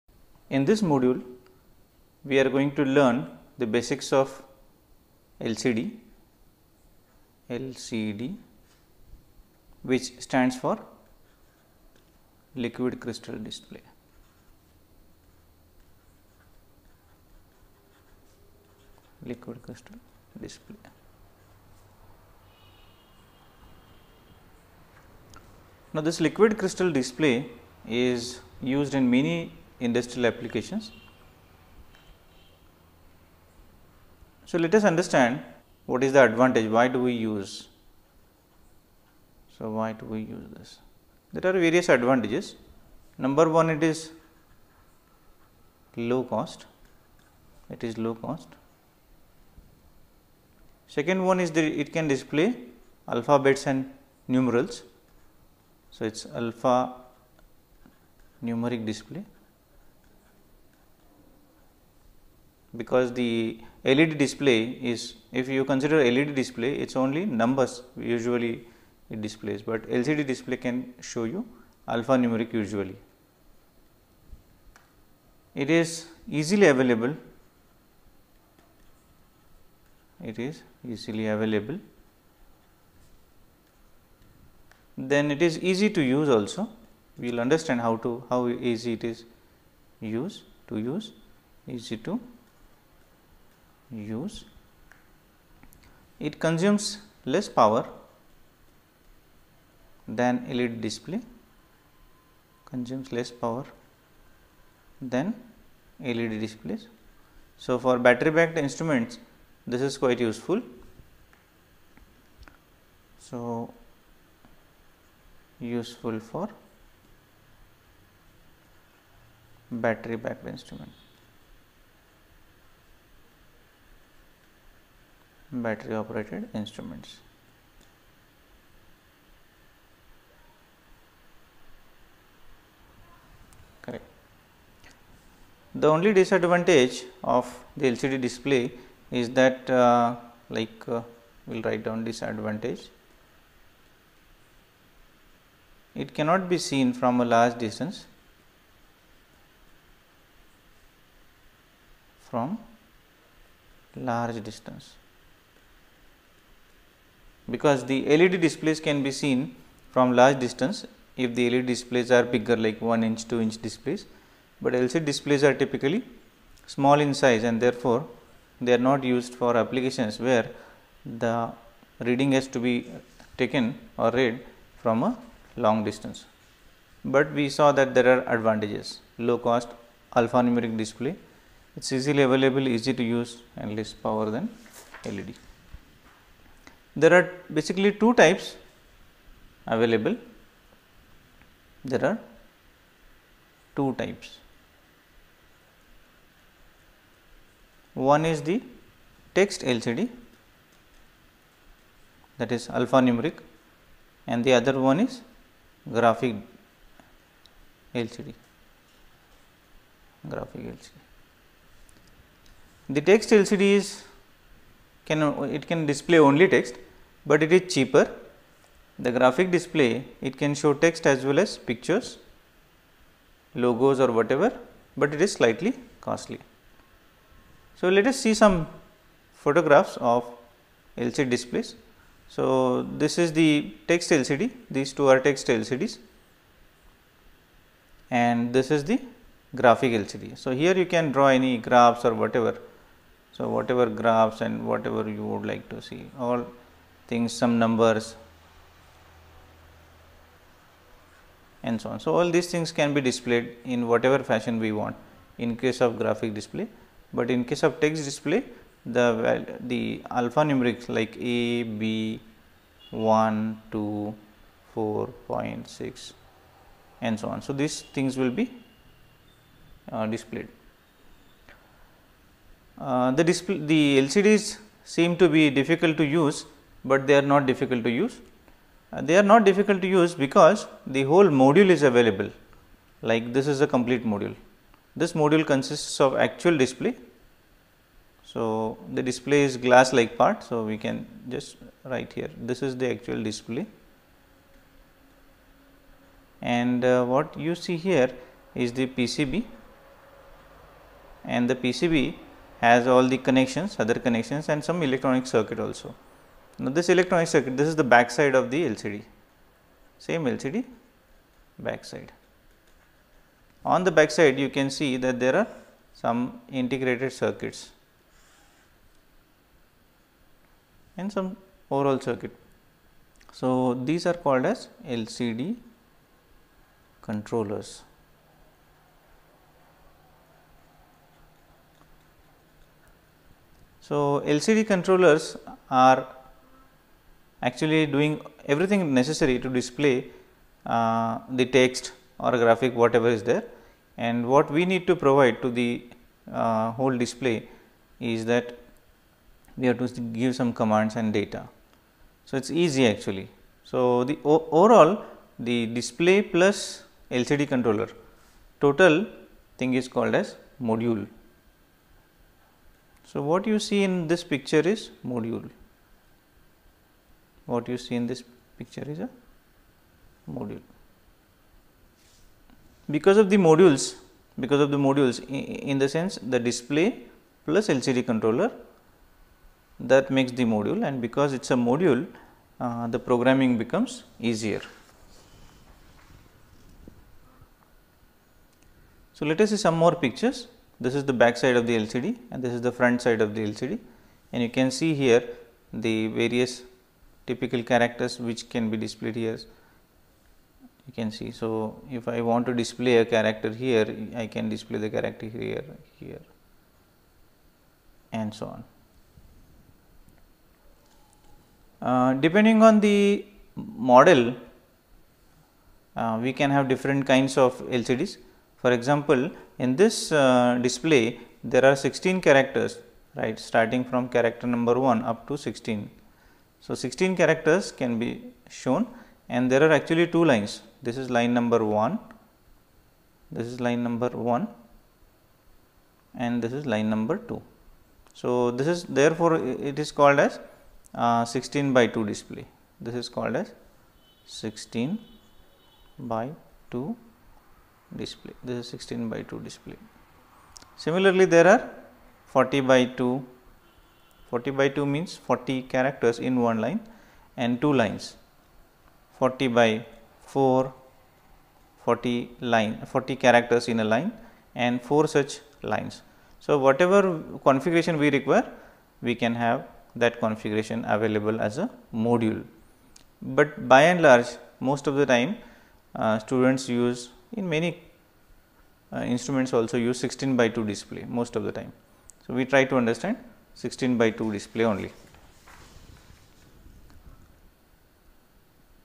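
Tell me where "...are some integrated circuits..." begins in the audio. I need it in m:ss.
5:15.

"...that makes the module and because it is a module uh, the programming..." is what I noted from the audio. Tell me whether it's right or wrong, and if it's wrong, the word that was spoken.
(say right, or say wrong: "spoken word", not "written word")
right.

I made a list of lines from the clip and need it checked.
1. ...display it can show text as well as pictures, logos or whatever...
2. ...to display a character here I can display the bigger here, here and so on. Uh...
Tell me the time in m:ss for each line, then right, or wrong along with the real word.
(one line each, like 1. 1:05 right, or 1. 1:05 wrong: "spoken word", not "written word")
1. 3:39 right
2. 6:42 wrong: "character", not "bigger".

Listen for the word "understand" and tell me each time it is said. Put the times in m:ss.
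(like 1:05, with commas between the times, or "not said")
0:34, 1:27, 8:02.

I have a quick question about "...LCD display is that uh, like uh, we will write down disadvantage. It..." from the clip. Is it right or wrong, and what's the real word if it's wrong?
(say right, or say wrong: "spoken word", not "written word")
right.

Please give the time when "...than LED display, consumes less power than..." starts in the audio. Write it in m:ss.
1:40.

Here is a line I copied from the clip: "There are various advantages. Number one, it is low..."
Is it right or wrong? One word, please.
right.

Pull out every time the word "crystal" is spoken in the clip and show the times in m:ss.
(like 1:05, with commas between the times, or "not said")
0:12, 0:19, 0:26.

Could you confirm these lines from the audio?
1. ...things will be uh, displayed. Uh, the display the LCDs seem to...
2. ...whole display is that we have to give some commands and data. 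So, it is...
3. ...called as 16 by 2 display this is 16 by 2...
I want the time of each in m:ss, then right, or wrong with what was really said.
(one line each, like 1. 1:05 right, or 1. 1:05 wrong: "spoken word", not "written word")
1. 4:27 right
2. 5:46 right
3. 7:23 right.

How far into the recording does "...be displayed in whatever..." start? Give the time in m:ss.
4:12.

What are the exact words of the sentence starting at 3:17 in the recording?
One is the text LCD that is alphanumeric and the other one is graphic LCD graphic LCD.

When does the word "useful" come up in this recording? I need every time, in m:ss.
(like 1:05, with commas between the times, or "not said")
1:50, 1:55.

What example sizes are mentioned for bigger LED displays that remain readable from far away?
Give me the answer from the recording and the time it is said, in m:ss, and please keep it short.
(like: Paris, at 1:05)
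1 inch 2 inch, at 2:42.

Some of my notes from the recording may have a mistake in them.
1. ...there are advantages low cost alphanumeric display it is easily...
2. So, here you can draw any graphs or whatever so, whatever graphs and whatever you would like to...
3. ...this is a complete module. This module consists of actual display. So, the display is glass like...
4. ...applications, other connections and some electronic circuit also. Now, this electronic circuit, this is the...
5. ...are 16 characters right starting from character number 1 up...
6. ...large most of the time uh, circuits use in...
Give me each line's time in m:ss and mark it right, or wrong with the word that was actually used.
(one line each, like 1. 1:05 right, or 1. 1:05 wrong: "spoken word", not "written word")
1. 2:57 right
2. 4:00 right
3. 4:43 right
4. 5:03 wrong: "connections", not "applications"
5. 7:01 right
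6. 7:54 wrong: "students", not "circuits".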